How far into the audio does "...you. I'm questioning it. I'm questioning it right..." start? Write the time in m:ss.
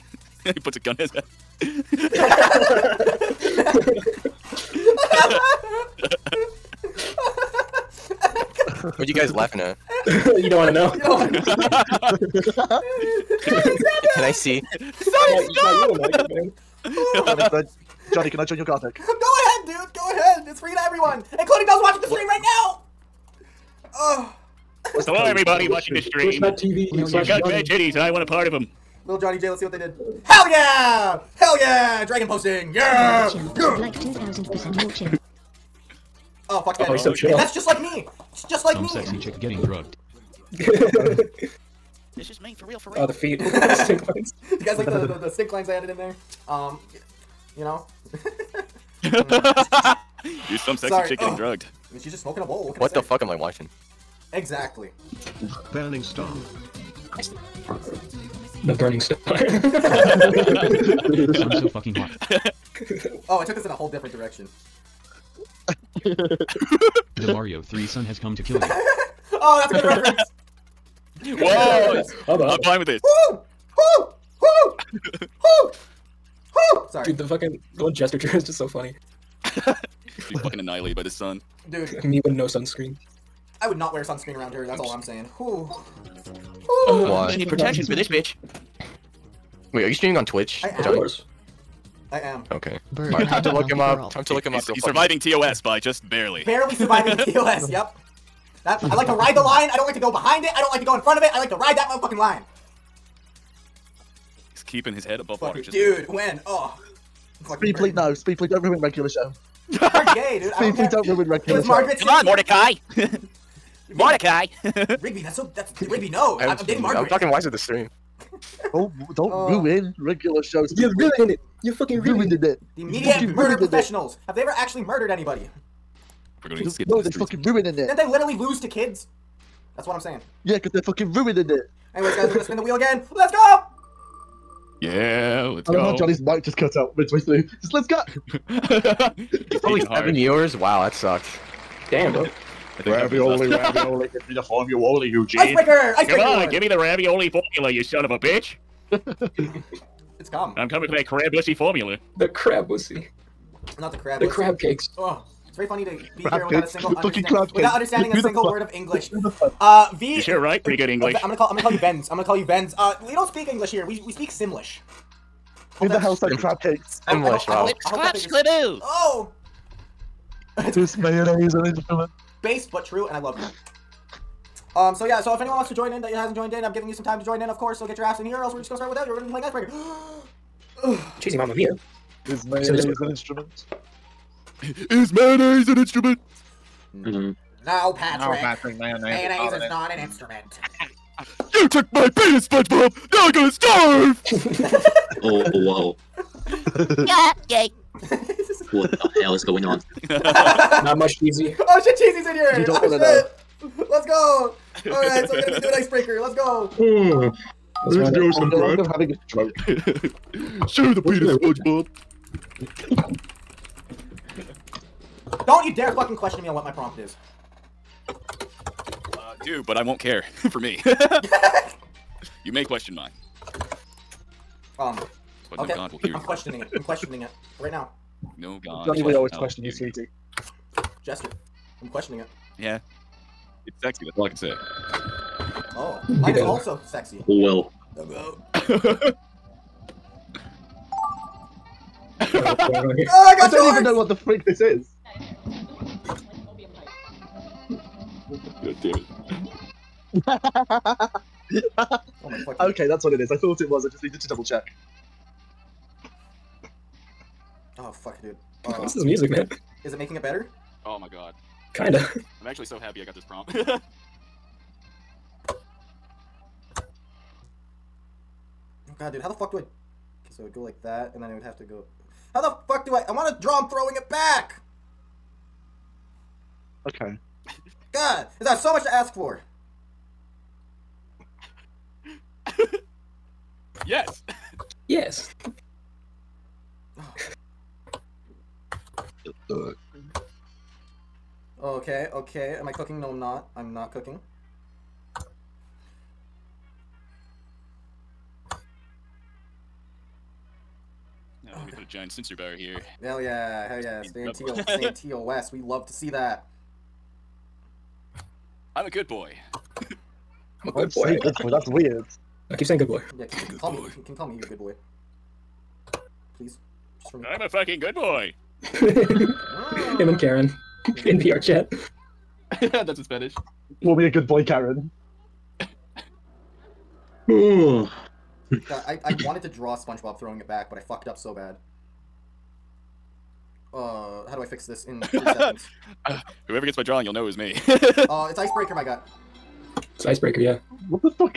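3:46.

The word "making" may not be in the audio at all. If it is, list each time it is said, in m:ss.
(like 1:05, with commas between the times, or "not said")
4:19.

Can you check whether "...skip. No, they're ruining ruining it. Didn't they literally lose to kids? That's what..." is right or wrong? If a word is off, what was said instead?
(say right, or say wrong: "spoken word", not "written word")
wrong: "fucking", not "ruining".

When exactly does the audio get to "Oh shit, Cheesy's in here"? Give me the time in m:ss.
3:21.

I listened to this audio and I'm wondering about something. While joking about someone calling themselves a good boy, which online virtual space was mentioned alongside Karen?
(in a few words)
VR chat.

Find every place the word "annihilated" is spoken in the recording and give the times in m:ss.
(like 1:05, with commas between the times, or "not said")
1:20.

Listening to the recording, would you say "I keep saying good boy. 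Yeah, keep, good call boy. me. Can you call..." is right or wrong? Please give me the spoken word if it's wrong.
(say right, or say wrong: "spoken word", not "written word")
right.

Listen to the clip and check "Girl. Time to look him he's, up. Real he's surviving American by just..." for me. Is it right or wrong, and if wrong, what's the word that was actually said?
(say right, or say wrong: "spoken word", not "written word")
wrong: "TOS", not "American".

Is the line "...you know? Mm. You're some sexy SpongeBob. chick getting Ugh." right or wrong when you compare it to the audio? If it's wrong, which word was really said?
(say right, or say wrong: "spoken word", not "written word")
wrong: "Sorry", not "SpongeBob".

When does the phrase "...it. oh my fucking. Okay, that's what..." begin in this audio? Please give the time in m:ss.
4:08.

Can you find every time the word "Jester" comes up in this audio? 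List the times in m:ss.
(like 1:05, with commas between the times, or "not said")
1:17, 3:51.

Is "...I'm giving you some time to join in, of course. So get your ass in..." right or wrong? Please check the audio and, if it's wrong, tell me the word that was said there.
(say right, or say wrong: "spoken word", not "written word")
right.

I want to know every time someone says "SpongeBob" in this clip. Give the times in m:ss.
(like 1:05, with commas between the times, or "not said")
3:12, 3:32, 5:29.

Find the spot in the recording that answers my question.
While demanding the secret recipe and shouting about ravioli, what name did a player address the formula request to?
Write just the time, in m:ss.
2:25.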